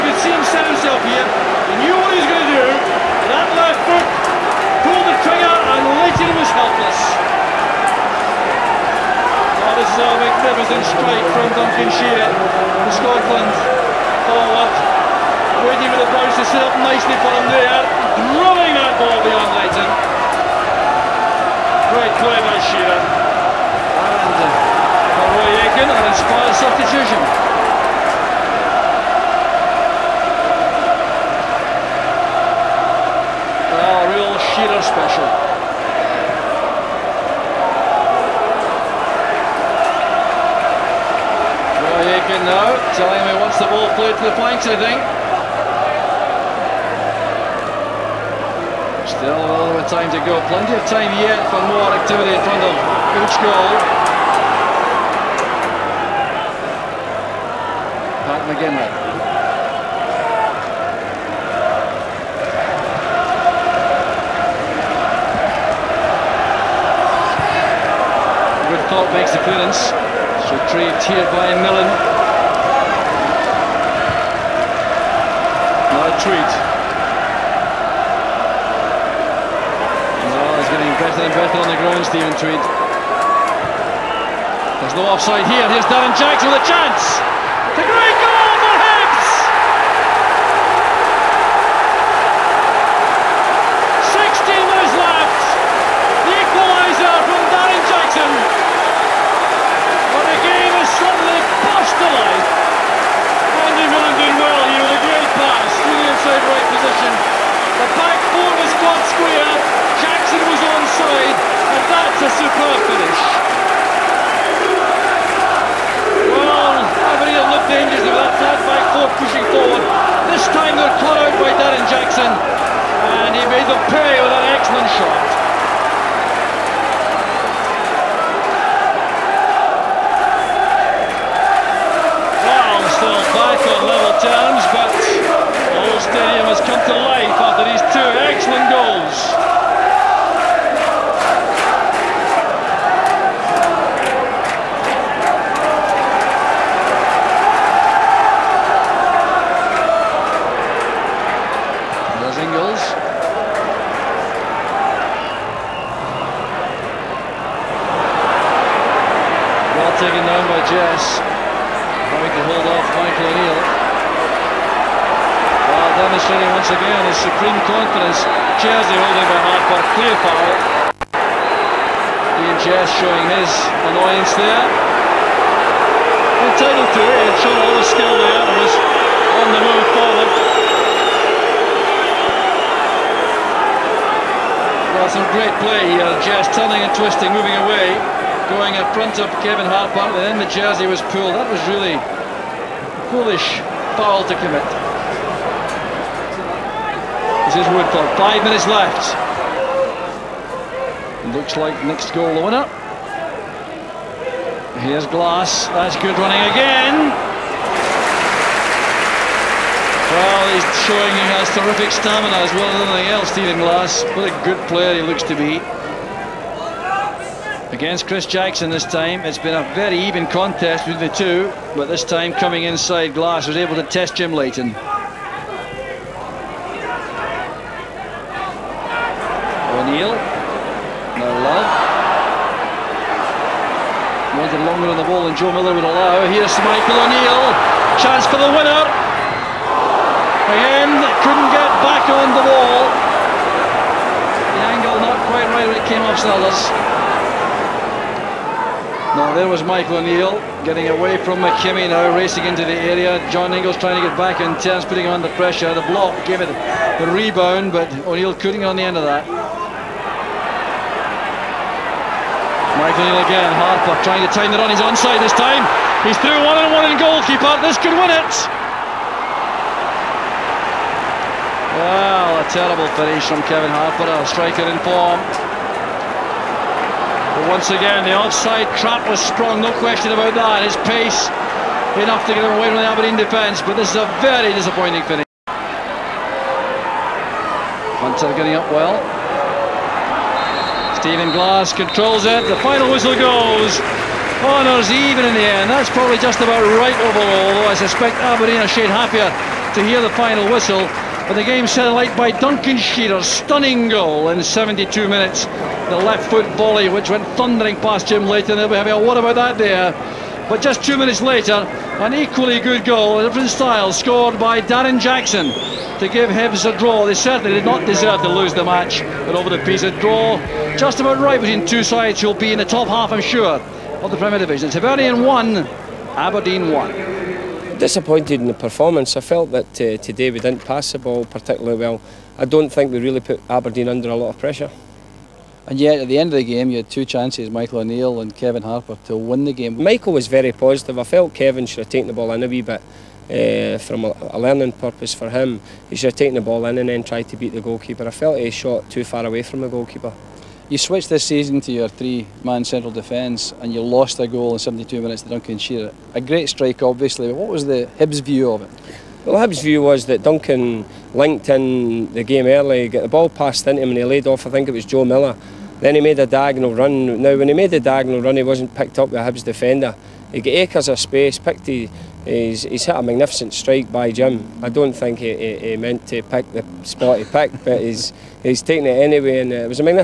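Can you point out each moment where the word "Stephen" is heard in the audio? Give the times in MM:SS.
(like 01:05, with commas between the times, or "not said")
01:22, 03:33, 04:51.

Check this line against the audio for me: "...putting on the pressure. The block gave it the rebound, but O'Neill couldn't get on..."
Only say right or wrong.
right.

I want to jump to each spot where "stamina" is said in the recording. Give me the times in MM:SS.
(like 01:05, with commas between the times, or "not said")
03:31.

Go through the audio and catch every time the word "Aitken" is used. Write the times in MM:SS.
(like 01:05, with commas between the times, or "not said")
00:25, 00:42.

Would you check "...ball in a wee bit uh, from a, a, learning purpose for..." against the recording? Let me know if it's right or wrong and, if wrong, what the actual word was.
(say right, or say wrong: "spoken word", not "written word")
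right.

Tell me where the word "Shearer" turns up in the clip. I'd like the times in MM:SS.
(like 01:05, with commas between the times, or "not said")
00:22, 00:34, 05:02, 05:55.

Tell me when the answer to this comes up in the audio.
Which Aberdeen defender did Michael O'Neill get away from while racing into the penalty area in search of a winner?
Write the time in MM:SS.
04:11.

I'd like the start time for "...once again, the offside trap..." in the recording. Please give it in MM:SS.
04:37.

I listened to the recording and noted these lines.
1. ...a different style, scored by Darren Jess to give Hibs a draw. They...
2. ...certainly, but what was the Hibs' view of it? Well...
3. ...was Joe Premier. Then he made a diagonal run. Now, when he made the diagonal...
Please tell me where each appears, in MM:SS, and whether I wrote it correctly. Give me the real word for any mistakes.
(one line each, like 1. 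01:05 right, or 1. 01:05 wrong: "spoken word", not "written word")
1. 05:13 wrong: "Jackson", not "Jess"
2. 05:56 wrong: "obviously", not "certainly"
3. 06:04 wrong: "Miller", not "Premier".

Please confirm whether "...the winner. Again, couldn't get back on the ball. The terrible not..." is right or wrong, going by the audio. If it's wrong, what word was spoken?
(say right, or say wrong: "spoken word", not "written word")
wrong: "angle", not "terrible".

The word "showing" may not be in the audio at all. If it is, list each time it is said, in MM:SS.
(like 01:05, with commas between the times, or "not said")
02:52, 03:30.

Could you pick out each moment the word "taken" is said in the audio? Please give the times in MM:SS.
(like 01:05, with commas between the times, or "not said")
05:41, 05:46, 06:18.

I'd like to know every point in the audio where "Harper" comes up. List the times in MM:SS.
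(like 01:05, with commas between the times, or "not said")
03:09, 04:23, 04:33, 05:38.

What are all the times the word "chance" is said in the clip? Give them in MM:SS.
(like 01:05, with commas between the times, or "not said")
01:26, 03:58, 05:37.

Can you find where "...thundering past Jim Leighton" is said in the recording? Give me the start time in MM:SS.
05:07.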